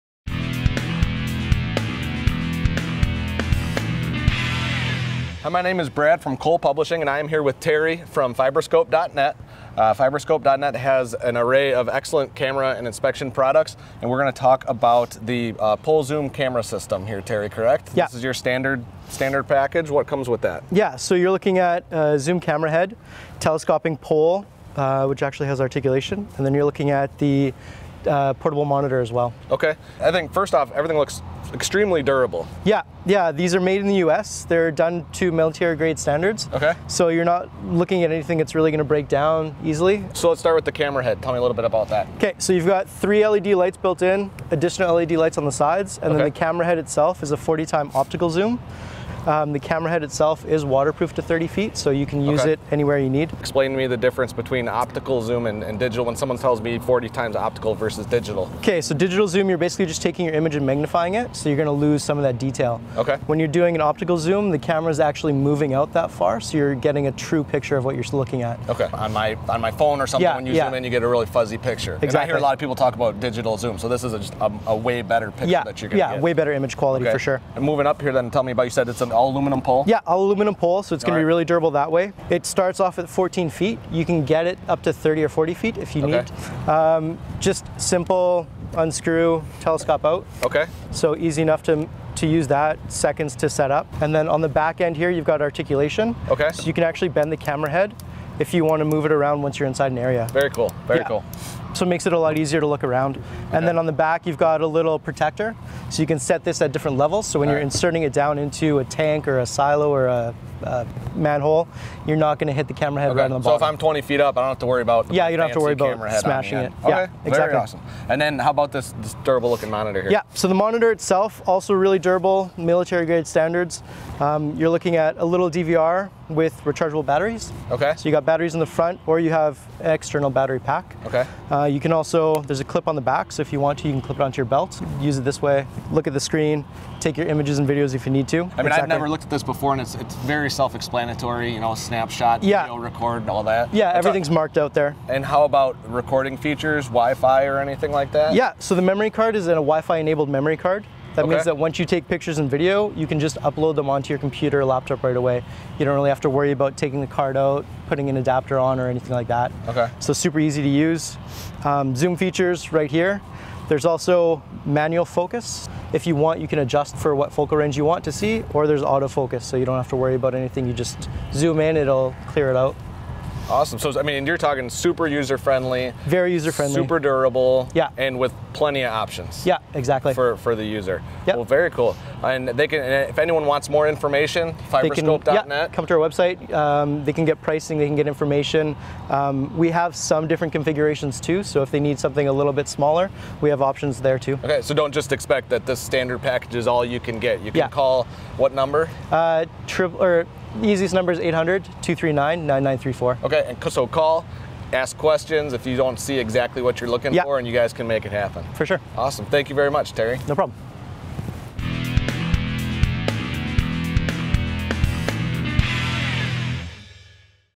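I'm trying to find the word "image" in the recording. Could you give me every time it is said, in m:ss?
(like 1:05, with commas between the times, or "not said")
1:00, 1:16, 2:17.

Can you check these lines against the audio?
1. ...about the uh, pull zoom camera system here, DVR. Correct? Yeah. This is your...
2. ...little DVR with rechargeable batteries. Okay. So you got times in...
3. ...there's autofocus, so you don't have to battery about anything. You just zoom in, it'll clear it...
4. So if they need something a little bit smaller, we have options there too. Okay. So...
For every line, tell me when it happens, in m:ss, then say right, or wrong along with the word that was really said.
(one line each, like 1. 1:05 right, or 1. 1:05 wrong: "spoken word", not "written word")
1. 0:14 wrong: "Terry", not "DVR"
2. 2:05 wrong: "batteries", not "times"
3. 2:48 wrong: "worry", not "battery"
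4. 3:11 right.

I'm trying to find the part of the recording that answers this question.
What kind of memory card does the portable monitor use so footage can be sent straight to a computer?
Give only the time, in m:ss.
2:29.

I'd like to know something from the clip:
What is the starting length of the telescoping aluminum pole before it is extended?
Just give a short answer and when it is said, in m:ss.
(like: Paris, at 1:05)
14 feet, at 1:23.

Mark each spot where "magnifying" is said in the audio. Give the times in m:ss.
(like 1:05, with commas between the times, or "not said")
1:00.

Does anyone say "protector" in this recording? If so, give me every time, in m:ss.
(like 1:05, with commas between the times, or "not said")
1:44.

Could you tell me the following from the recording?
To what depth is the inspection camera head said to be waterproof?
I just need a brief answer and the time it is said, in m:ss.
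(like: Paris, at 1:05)
30 feet, at 0:51.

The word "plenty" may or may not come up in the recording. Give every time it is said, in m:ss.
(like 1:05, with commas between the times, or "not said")
2:58.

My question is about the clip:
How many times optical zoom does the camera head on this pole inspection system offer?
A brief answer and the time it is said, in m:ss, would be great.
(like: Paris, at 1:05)
40, at 0:47.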